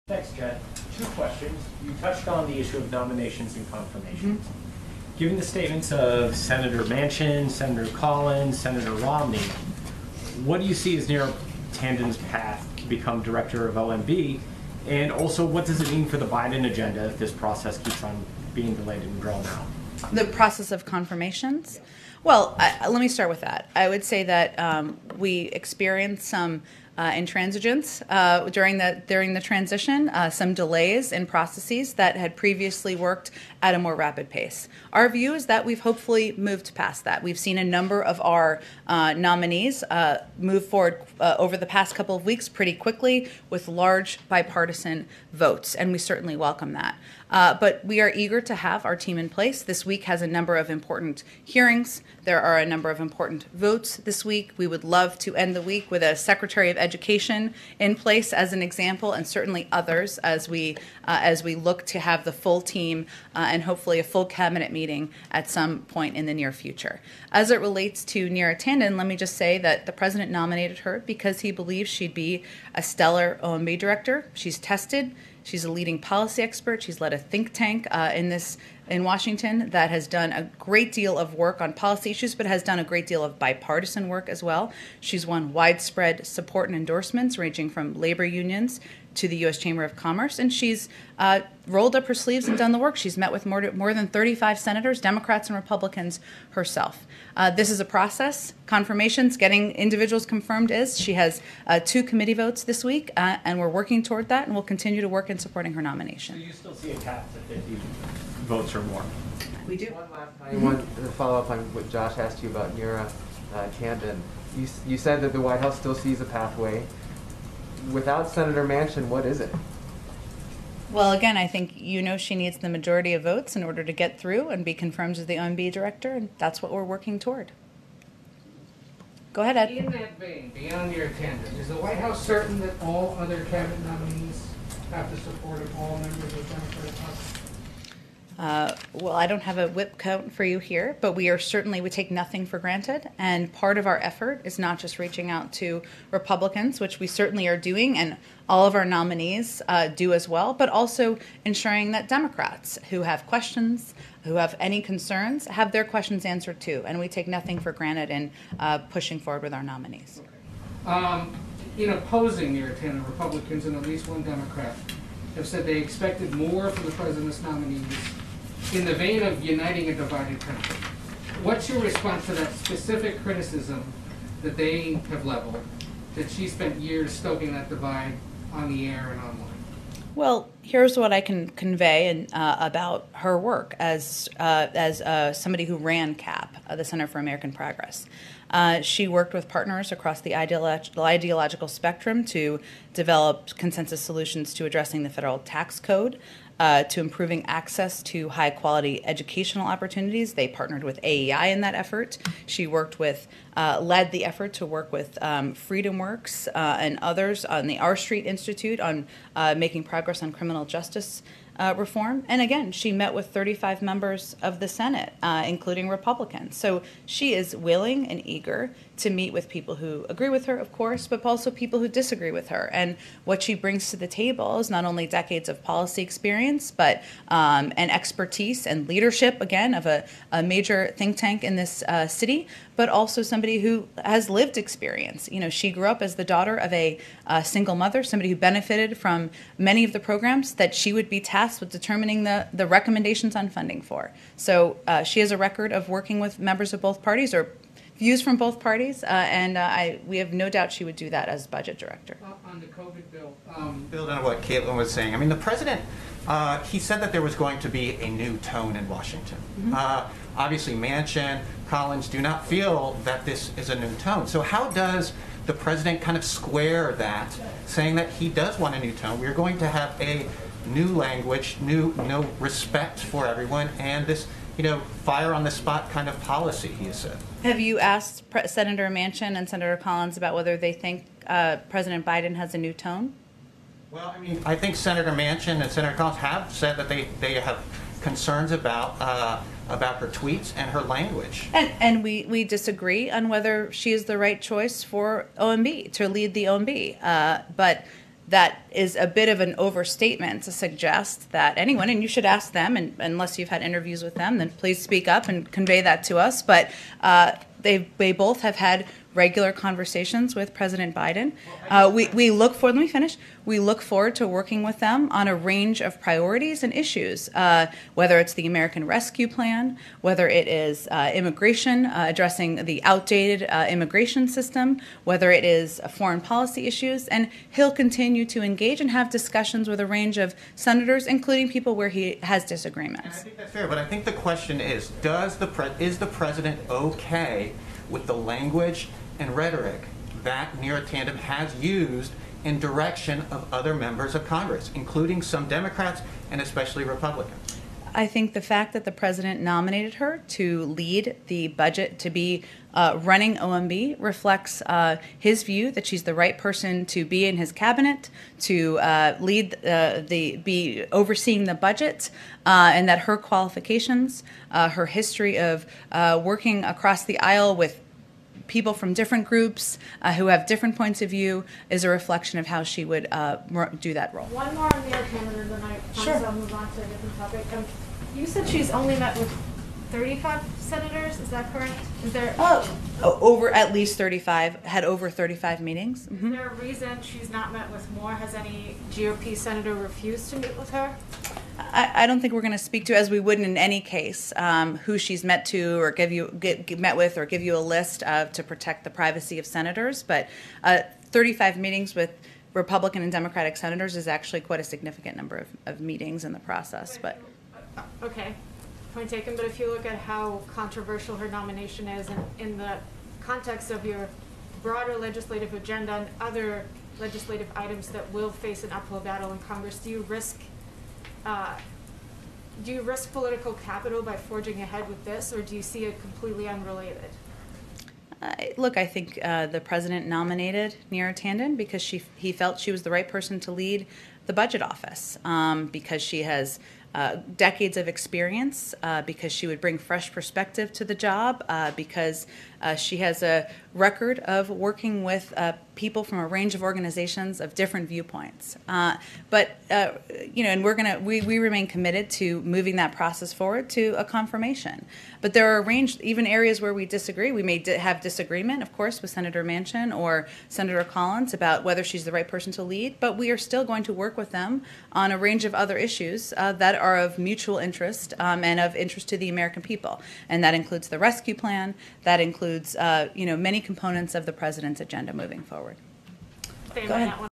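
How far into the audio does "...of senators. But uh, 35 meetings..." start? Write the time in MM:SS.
06:39.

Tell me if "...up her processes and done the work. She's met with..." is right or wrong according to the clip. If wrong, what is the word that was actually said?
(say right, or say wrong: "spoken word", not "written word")
wrong: "sleeves", not "processes".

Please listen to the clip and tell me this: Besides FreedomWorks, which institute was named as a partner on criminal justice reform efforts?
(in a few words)
R Street Institute.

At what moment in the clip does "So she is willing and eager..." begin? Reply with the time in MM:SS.
03:36.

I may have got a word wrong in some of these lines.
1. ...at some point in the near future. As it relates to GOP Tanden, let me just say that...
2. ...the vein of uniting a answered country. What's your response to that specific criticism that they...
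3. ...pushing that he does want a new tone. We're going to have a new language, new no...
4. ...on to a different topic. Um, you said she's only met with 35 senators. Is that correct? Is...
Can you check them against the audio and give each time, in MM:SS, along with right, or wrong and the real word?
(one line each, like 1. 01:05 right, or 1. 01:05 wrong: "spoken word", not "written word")
1. 01:05 wrong: "Neera", not "GOP"
2. 02:48 wrong: "divided", not "answered"
3. 04:27 wrong: "saying", not "pushing"
4. 06:16 right.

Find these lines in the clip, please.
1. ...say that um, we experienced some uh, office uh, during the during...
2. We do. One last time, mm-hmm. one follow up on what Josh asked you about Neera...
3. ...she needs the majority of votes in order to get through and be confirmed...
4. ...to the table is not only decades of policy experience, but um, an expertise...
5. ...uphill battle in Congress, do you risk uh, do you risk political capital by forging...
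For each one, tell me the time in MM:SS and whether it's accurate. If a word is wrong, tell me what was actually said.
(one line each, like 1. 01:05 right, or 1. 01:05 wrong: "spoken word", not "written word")
1. 00:24 wrong: "intransigence", not "office"
2. 01:49 right
3. 02:02 right
4. 03:43 right
5. 06:58 right.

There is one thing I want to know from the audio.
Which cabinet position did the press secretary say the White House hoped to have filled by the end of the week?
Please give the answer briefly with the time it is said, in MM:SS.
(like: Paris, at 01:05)
Secretary of education, at 00:56.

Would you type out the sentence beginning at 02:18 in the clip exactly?
Uh, well, I don't have a whip count for you here, but we are certainly, we take nothing for granted.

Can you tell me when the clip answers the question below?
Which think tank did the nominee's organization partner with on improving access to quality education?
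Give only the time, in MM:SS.
03:21.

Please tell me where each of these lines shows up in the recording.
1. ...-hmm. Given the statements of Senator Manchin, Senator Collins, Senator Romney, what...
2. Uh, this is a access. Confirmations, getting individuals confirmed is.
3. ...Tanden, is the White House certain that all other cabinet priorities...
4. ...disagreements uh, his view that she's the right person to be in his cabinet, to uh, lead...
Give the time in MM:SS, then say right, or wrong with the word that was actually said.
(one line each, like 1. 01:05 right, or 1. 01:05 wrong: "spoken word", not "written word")
1. 00:04 right
2. 01:37 wrong: "process", not "access"
3. 02:11 wrong: "nominees", not "priorities"
4. 05:53 wrong: "reflects", not "disagreements".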